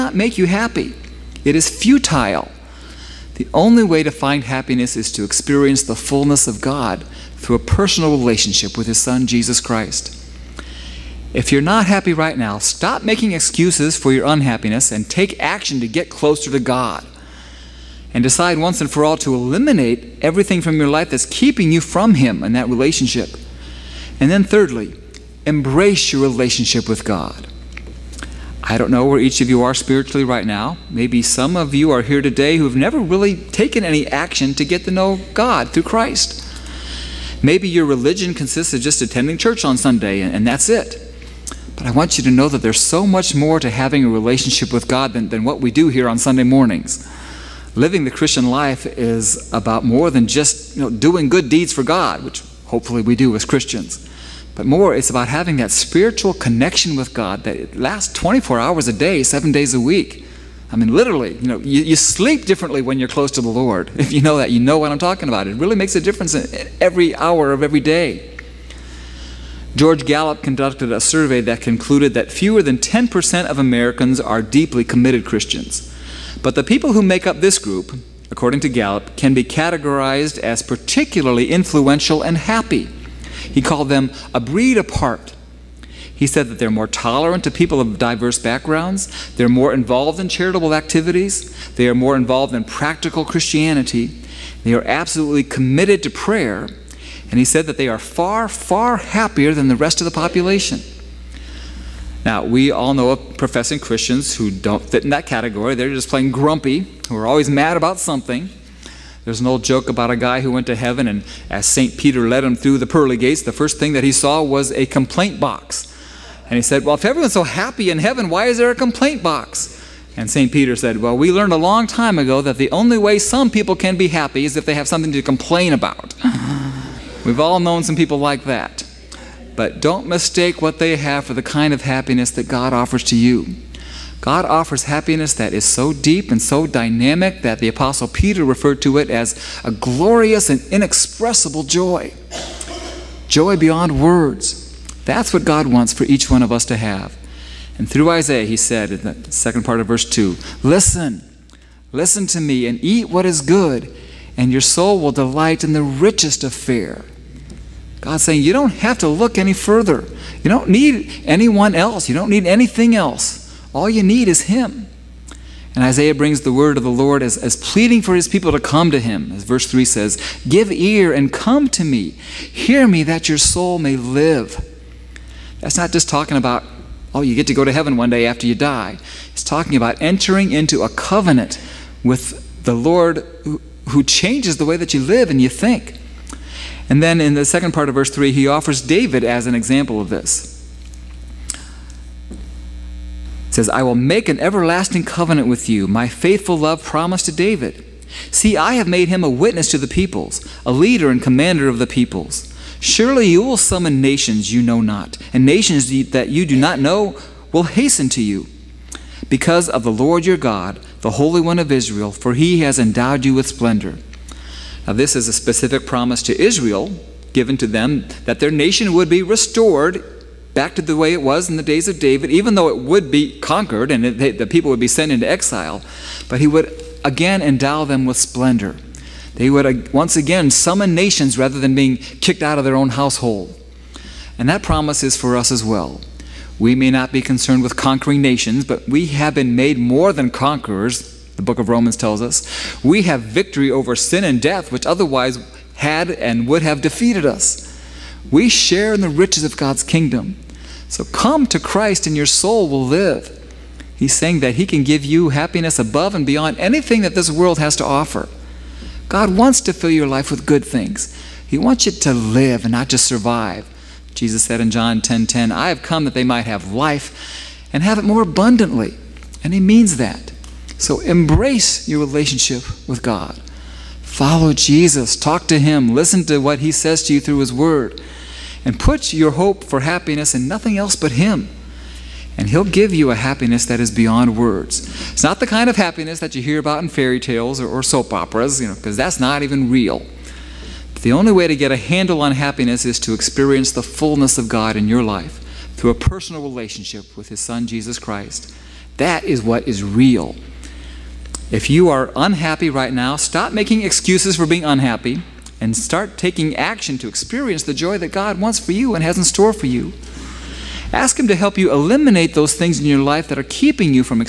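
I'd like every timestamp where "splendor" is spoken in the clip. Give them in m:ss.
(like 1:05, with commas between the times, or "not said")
3:33, 3:48.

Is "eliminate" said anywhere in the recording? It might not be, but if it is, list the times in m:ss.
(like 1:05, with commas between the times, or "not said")
0:19, 5:11.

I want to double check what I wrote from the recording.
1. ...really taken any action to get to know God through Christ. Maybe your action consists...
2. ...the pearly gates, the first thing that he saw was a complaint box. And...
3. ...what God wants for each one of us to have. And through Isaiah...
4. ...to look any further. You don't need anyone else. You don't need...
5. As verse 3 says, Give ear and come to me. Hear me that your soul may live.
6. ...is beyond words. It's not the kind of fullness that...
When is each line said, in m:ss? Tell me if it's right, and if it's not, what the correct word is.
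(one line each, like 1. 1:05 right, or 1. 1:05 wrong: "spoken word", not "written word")
1. 0:32 wrong: "religion", not "action"
2. 1:52 right
3. 2:25 right
4. 2:38 right
5. 2:49 right
6. 4:43 wrong: "happiness", not "fullness".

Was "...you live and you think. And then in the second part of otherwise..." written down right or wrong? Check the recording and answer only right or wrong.
wrong.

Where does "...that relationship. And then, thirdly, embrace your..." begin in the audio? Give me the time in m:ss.
0:22.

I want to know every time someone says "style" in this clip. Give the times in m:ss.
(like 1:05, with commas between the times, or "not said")
not said.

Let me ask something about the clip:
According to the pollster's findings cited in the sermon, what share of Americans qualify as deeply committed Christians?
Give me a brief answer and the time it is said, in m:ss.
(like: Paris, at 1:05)
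fewer than 10%, at 1:12.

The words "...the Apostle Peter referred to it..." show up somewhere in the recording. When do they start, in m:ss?
2:17.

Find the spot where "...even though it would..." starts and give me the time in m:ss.
3:42.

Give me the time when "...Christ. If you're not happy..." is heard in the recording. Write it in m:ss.
0:09.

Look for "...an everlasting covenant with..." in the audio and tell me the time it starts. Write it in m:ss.
3:14.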